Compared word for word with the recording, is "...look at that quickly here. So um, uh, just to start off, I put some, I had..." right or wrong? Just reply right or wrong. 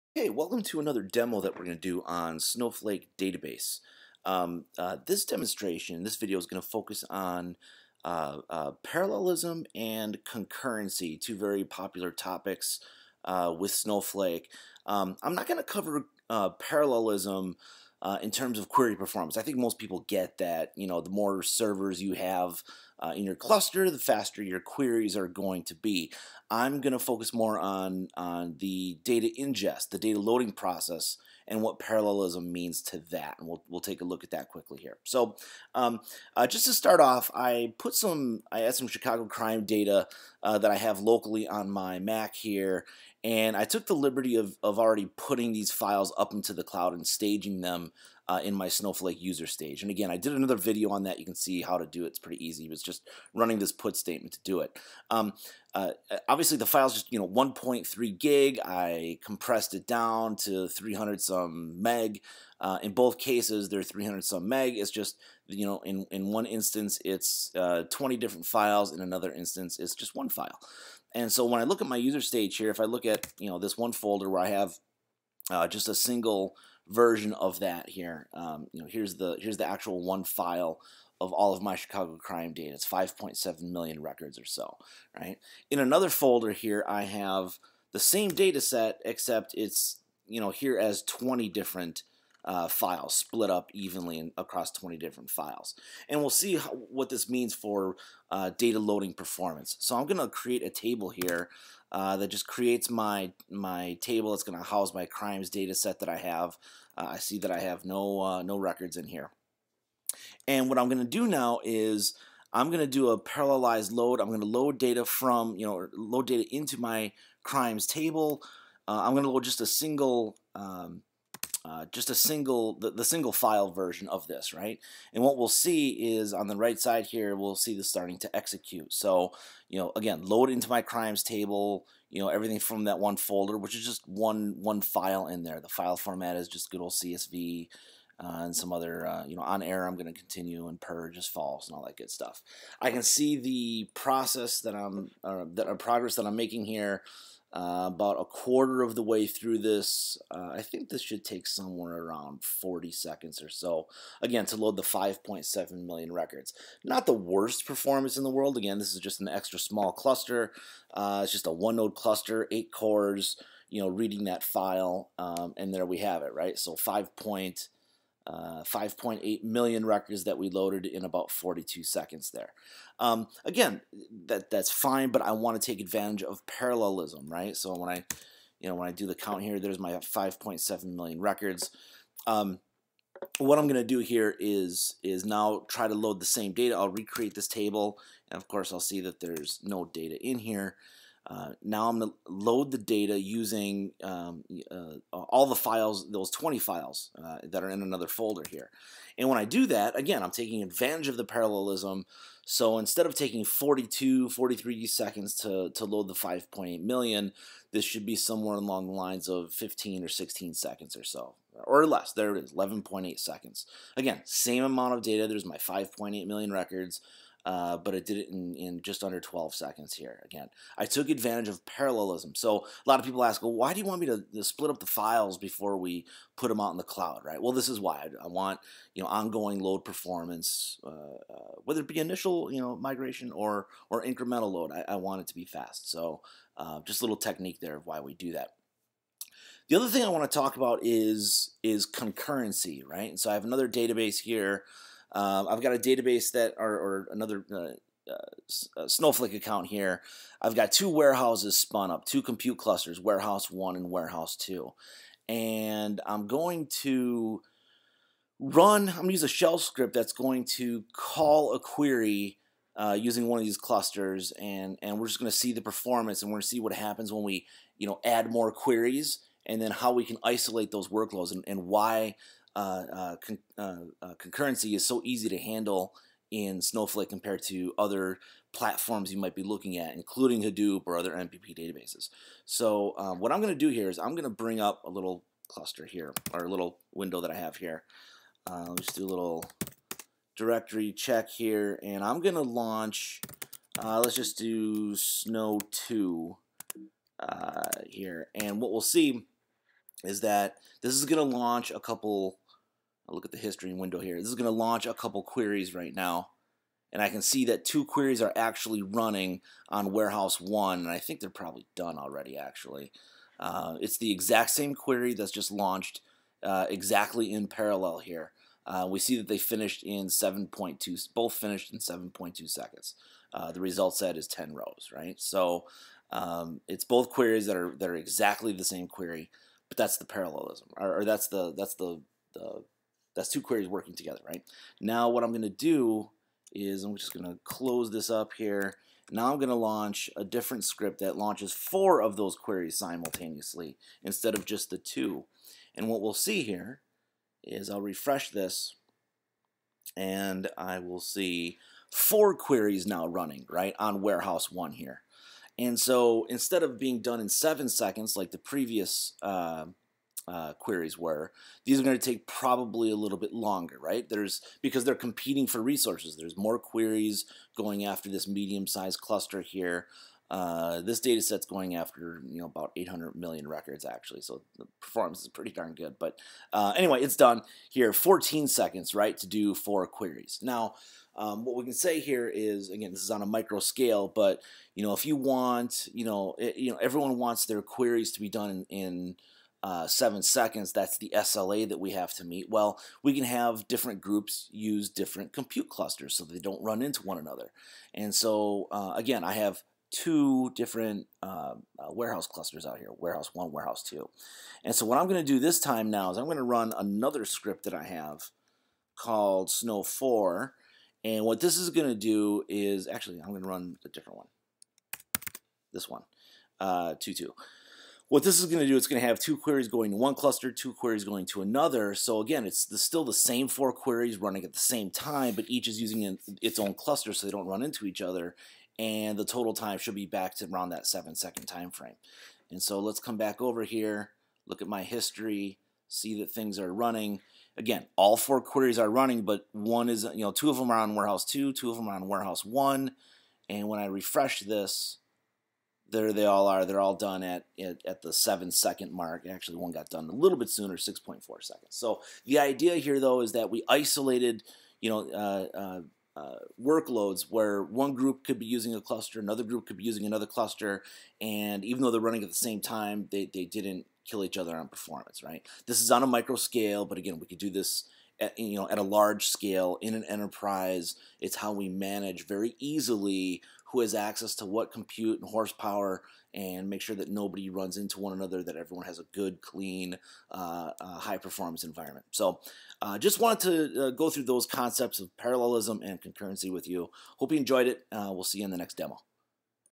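right.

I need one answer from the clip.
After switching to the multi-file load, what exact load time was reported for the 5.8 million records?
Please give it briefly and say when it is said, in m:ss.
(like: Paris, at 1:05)
11.8 seconds, at 3:32.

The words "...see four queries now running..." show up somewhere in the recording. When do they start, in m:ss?
5:51.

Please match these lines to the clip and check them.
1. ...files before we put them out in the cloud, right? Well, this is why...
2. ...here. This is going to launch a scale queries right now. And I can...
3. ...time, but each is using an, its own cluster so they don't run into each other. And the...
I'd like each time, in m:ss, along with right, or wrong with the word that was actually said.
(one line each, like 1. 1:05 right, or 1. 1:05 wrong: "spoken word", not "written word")
1. 3:44 right
2. 5:03 wrong: "couple", not "scale"
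3. 7:04 right.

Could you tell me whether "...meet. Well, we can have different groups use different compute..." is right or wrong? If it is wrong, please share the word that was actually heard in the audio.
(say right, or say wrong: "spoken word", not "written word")
right.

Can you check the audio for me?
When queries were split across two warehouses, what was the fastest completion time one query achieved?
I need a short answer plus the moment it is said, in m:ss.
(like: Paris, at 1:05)
6.4 seconds, at 7:30.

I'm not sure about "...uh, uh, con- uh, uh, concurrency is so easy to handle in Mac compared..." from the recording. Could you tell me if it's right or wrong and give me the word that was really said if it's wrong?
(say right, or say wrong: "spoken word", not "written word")
wrong: "Snowflake", not "Mac".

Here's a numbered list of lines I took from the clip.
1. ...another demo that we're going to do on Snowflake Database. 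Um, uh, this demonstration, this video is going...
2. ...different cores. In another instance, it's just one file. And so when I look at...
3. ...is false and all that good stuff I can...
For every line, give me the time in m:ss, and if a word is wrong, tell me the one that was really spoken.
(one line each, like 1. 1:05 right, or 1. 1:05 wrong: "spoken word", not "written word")
1. 0:00 right
2. 1:08 wrong: "files", not "cores"
3. 2:21 right.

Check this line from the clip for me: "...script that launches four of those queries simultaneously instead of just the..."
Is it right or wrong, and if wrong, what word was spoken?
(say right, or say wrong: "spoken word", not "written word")
right.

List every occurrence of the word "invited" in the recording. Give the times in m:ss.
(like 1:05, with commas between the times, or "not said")
not said.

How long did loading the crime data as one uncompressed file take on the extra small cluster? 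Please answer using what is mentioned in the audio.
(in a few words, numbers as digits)
42 seconds.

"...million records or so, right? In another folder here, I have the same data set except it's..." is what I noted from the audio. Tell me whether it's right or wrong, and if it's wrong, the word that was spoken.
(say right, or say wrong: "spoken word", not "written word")
right.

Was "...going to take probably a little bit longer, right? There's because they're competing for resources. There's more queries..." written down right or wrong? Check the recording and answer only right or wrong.
right.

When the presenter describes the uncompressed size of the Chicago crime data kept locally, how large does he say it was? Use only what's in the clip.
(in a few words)
1.3 gig.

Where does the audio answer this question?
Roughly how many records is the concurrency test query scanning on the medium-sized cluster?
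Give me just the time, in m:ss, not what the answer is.
6:12.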